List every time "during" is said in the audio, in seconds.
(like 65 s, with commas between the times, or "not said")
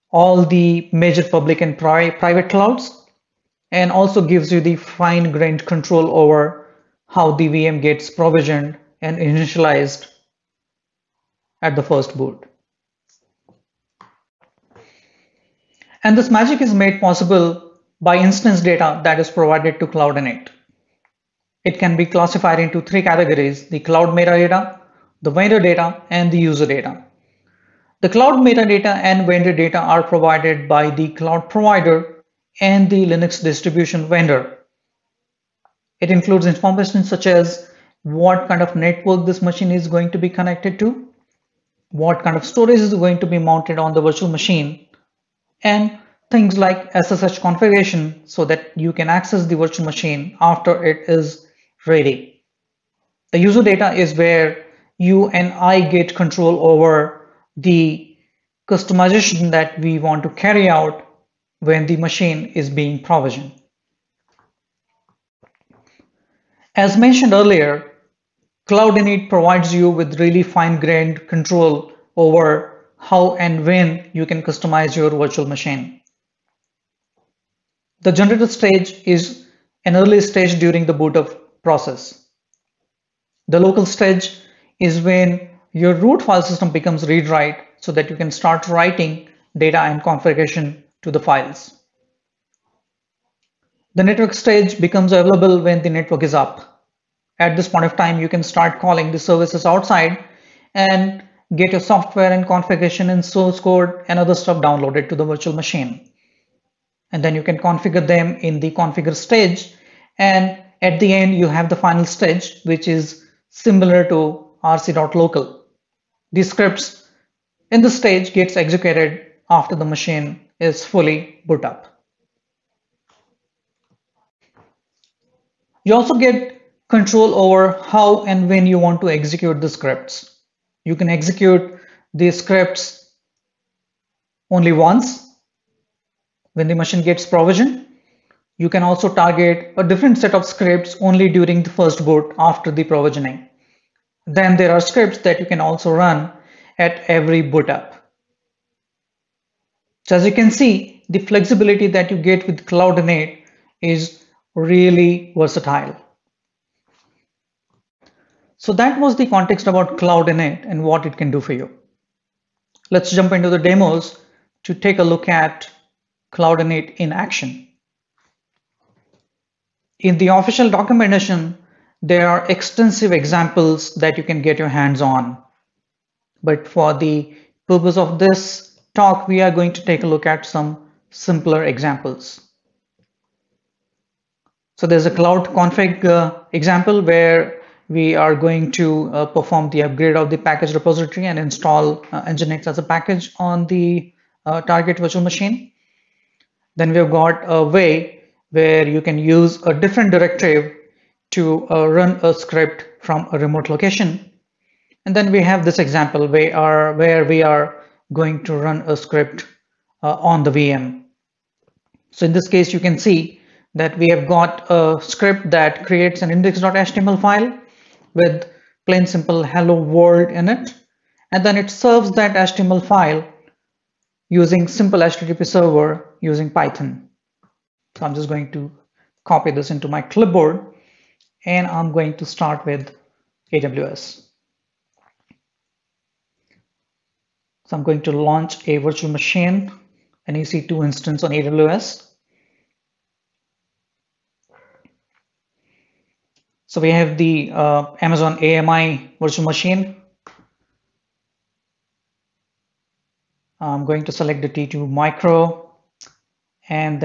80 s, 141 s.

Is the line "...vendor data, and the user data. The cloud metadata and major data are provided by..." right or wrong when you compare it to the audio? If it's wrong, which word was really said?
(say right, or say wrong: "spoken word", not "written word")
wrong: "vendor", not "major".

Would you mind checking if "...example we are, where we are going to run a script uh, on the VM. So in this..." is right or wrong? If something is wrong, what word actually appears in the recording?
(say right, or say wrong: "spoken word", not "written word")
right.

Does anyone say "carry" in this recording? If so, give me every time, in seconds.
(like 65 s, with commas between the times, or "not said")
60 s.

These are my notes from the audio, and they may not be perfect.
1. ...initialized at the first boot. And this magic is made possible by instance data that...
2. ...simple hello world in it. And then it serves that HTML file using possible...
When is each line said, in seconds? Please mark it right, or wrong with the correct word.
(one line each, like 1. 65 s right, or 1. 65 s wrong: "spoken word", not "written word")
1. 9 s right
2. 219 s wrong: "simple", not "possible".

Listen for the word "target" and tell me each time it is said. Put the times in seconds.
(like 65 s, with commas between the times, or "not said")
139 s, 194 s.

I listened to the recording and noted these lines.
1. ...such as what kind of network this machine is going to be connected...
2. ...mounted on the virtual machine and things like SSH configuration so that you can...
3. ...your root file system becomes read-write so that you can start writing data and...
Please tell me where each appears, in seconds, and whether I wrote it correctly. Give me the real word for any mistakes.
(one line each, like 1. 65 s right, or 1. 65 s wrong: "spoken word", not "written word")
1. 37 s right
2. 43 s right
3. 85 s right.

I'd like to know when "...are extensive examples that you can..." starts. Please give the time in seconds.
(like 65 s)
172 s.